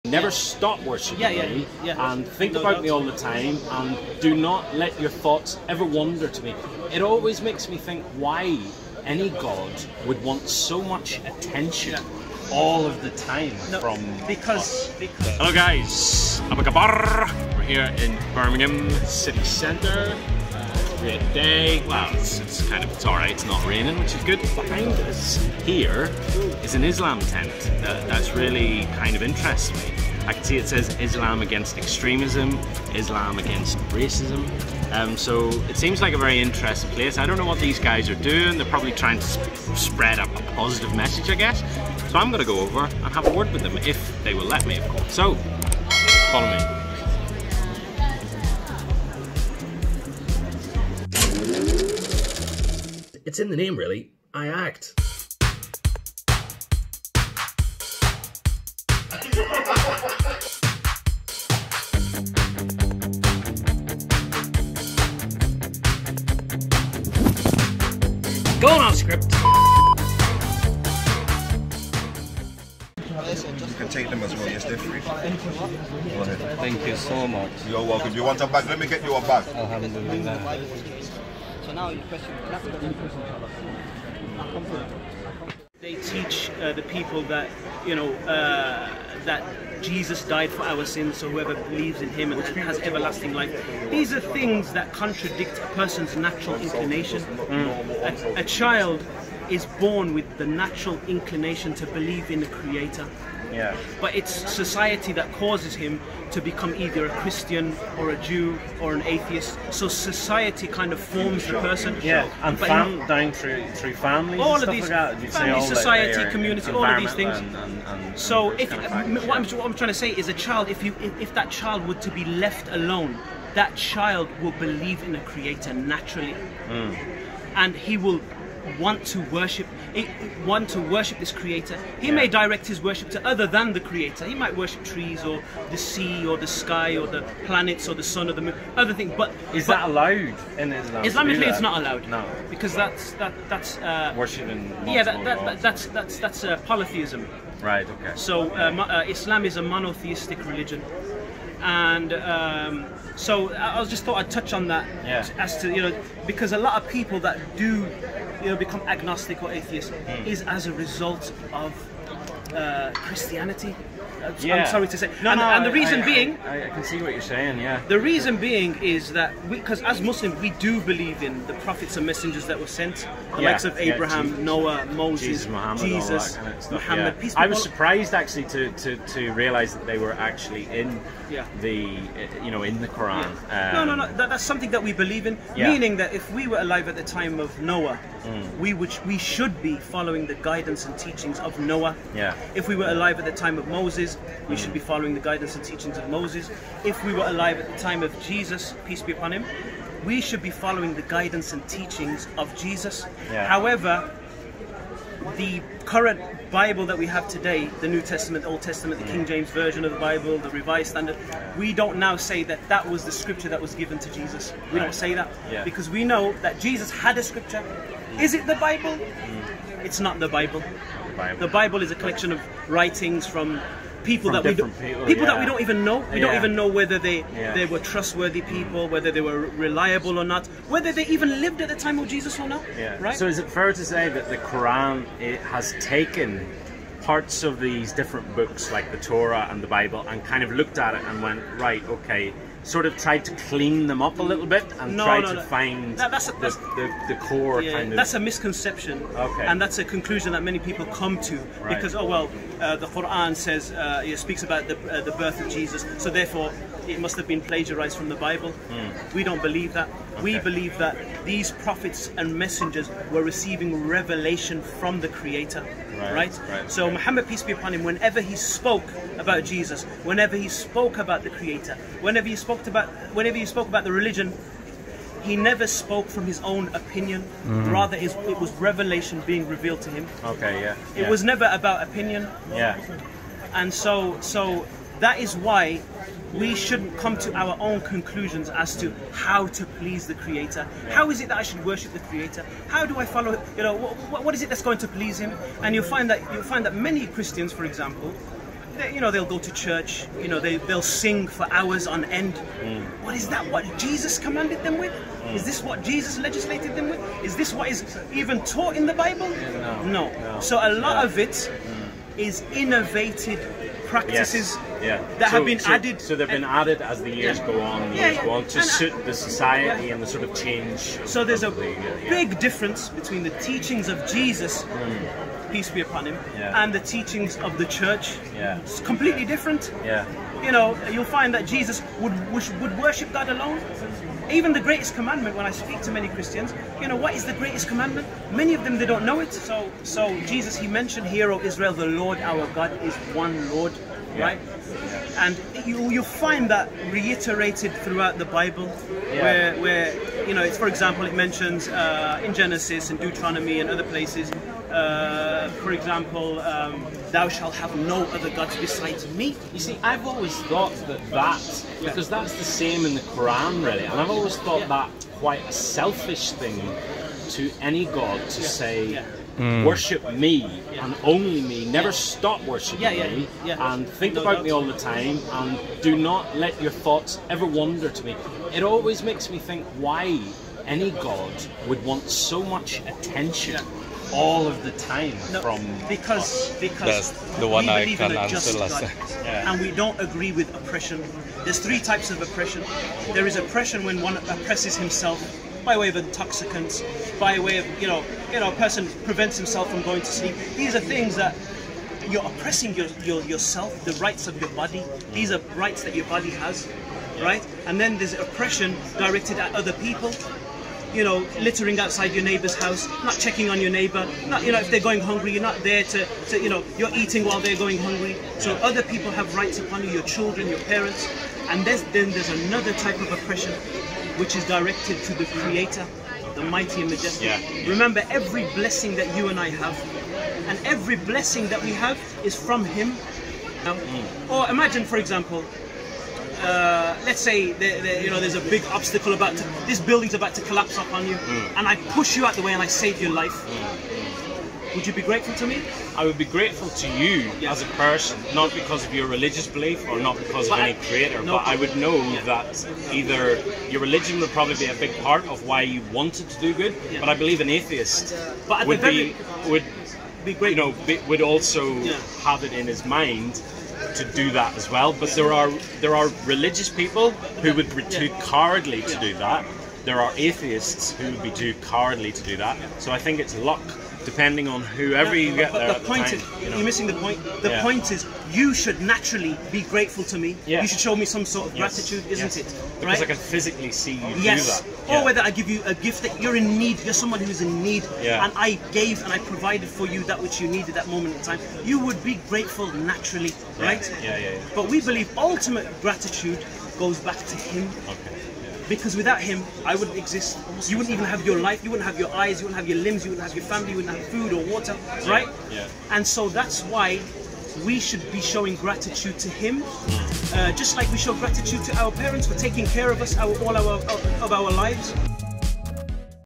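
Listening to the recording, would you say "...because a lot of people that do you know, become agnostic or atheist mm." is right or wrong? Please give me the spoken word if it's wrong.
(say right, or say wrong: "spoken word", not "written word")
right.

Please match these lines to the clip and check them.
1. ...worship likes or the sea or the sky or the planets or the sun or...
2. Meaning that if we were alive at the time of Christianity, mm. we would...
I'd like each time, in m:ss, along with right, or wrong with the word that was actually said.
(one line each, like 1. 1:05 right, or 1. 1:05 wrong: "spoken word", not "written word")
1. 2:14 wrong: "trees", not "likes"
2. 3:05 wrong: "Noah", not "Christianity".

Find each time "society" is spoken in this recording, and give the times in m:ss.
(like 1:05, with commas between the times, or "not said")
1:44, 1:49, 1:55, 5:19.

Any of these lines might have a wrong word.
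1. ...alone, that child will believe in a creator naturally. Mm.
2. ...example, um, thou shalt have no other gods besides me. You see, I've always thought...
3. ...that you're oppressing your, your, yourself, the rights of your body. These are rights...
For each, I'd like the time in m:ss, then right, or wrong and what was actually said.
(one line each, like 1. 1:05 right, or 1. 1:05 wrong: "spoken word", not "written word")
1. 2:02 right
2. 5:55 right
3. 6:41 right.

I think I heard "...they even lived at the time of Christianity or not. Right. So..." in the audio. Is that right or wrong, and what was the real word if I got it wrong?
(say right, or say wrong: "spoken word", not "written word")
wrong: "Jesus", not "Christianity".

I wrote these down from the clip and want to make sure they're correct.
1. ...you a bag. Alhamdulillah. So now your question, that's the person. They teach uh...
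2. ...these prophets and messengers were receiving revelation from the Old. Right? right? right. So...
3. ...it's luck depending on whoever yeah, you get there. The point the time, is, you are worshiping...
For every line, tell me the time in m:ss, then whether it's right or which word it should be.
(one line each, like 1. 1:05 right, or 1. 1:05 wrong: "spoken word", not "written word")
1. 1:19 wrong: "question", not "person"
2. 4:21 wrong: "Creator", not "Old"
3. 7:53 wrong: "missing", not "worshiping".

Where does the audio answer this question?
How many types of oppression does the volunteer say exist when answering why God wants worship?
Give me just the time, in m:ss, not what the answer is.
6:31.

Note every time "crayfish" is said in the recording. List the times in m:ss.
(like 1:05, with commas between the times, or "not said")
not said.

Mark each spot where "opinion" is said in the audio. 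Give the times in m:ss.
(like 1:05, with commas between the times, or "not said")
4:36, 4:41.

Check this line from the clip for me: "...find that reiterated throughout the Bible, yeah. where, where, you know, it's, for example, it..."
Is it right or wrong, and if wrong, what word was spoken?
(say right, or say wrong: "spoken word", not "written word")
right.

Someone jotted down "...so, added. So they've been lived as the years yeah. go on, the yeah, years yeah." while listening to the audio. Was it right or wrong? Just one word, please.
wrong.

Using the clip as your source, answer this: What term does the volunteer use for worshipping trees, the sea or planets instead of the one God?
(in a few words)
Polytheism.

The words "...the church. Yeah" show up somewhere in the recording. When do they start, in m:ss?
5:27.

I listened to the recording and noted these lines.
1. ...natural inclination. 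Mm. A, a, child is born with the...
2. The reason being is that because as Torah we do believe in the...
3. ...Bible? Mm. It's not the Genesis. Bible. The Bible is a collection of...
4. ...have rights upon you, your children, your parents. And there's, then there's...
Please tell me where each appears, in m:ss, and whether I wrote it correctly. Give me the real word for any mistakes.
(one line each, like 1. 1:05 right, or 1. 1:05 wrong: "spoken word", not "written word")
1. 1:36 right
2. 2:47 wrong: "Muslims", not "Torah"
3. 3:38 wrong: "Bible", not "Genesis"
4. 6:59 right.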